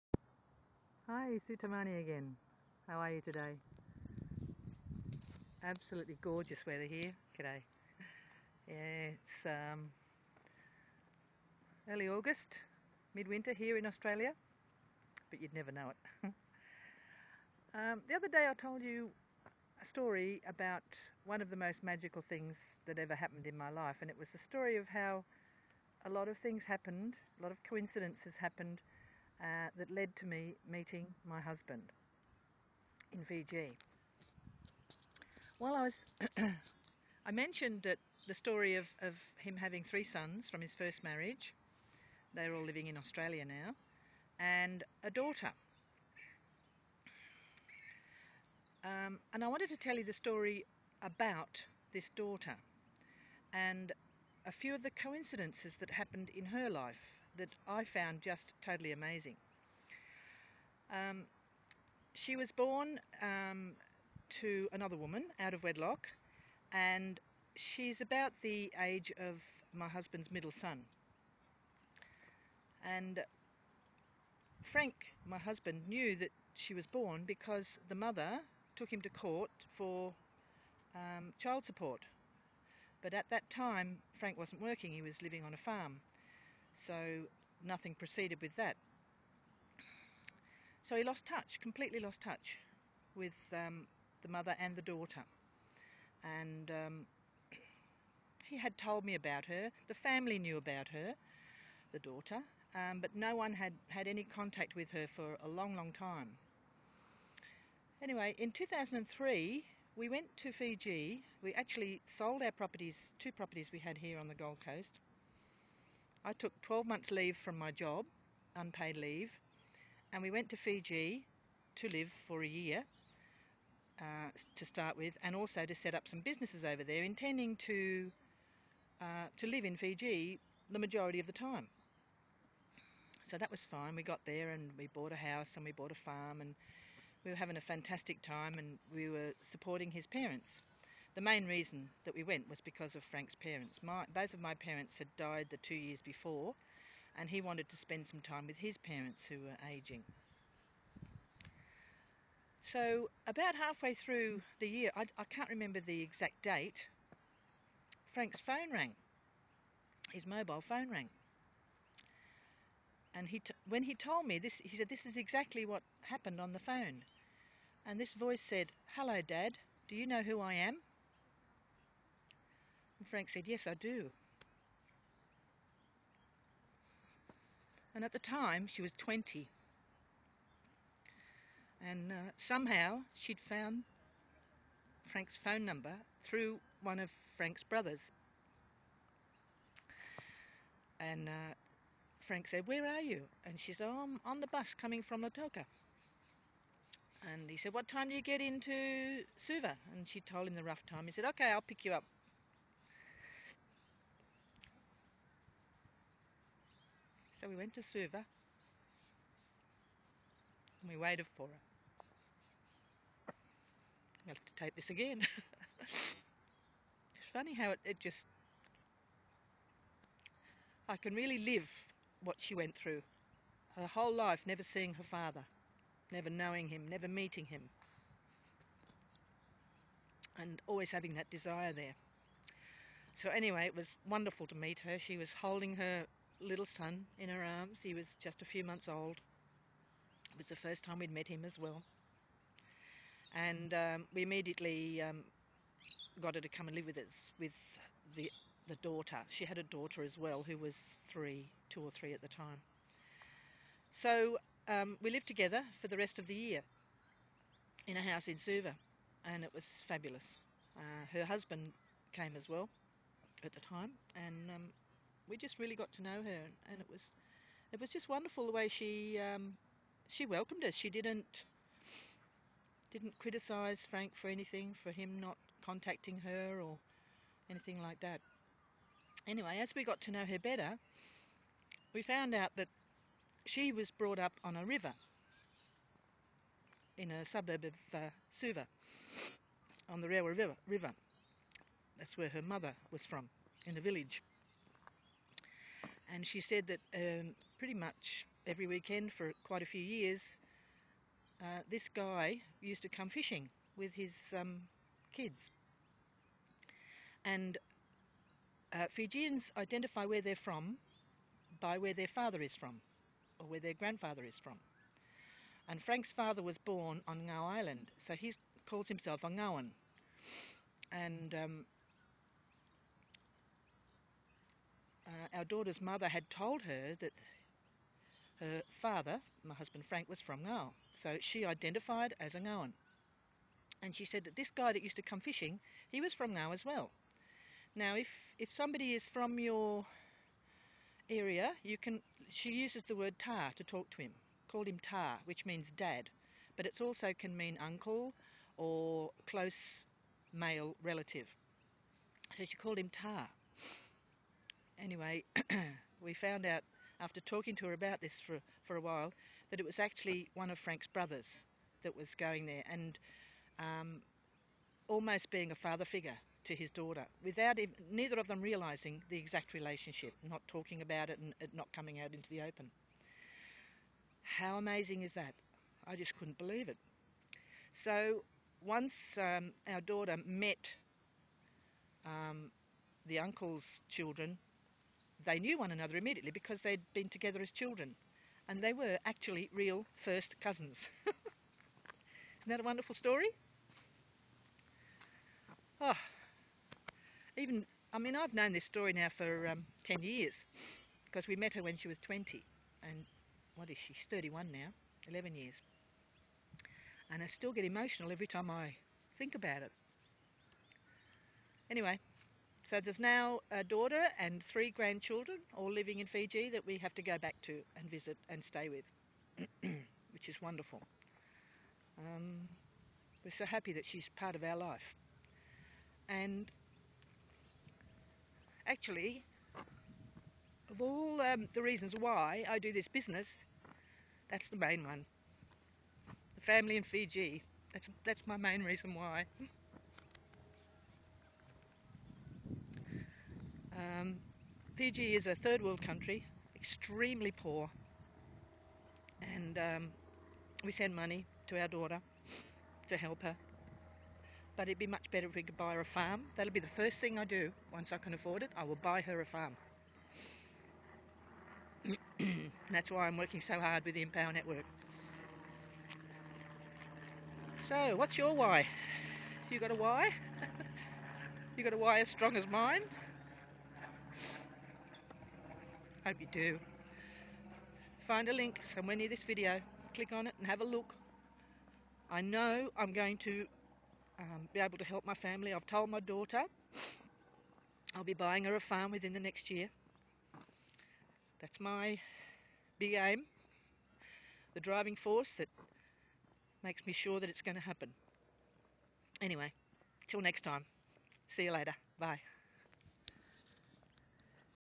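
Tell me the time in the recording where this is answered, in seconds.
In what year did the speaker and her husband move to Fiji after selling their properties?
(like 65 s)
108 s.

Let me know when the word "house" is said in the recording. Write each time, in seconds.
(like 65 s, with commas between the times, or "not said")
135 s, 258 s.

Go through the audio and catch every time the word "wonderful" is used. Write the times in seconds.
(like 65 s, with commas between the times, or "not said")
234 s, 268 s, 392 s, 420 s.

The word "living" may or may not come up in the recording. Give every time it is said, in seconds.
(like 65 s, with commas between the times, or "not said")
42 s, 85 s, 415 s.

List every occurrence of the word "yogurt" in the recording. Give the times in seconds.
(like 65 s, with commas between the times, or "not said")
not said.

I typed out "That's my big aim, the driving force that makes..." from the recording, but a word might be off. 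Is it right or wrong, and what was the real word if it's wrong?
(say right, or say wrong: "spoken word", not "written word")
right.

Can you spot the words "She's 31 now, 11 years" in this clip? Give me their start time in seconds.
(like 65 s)
403 s.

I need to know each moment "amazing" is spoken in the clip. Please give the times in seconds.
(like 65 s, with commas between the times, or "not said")
58 s, 374 s.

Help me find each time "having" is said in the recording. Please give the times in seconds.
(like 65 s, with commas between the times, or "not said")
39 s, 137 s, 230 s.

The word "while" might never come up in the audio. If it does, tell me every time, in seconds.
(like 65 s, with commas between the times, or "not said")
35 s, 358 s.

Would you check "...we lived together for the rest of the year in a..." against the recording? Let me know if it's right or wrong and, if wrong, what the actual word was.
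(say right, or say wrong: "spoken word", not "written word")
right.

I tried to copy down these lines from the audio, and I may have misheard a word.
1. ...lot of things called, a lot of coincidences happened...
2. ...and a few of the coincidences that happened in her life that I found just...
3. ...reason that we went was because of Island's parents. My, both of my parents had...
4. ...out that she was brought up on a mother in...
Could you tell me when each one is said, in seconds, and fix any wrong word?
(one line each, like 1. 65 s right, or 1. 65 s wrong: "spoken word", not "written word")
1. 26 s wrong: "happened", not "called"
2. 53 s right
3. 141 s wrong: "Frank", not "Island"
4. 282 s wrong: "river", not "mother".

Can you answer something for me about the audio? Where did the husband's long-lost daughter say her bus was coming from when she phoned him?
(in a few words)
Lautoka.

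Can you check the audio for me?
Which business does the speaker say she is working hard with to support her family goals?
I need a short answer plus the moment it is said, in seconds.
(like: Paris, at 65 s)
Empower Network, at 464 s.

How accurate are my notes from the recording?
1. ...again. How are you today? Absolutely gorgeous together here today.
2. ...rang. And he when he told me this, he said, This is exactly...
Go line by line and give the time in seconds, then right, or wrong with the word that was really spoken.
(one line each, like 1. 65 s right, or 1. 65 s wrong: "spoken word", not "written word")
1. 1 s wrong: "weather", not "together"
2. 160 s right.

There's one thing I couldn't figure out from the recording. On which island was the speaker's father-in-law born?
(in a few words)
Ngao Island.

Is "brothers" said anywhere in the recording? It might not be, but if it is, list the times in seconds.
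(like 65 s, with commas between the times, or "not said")
187 s, 360 s.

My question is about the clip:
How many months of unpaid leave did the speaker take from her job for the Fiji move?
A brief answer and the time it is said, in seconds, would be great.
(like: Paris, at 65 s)
12, at 116 s.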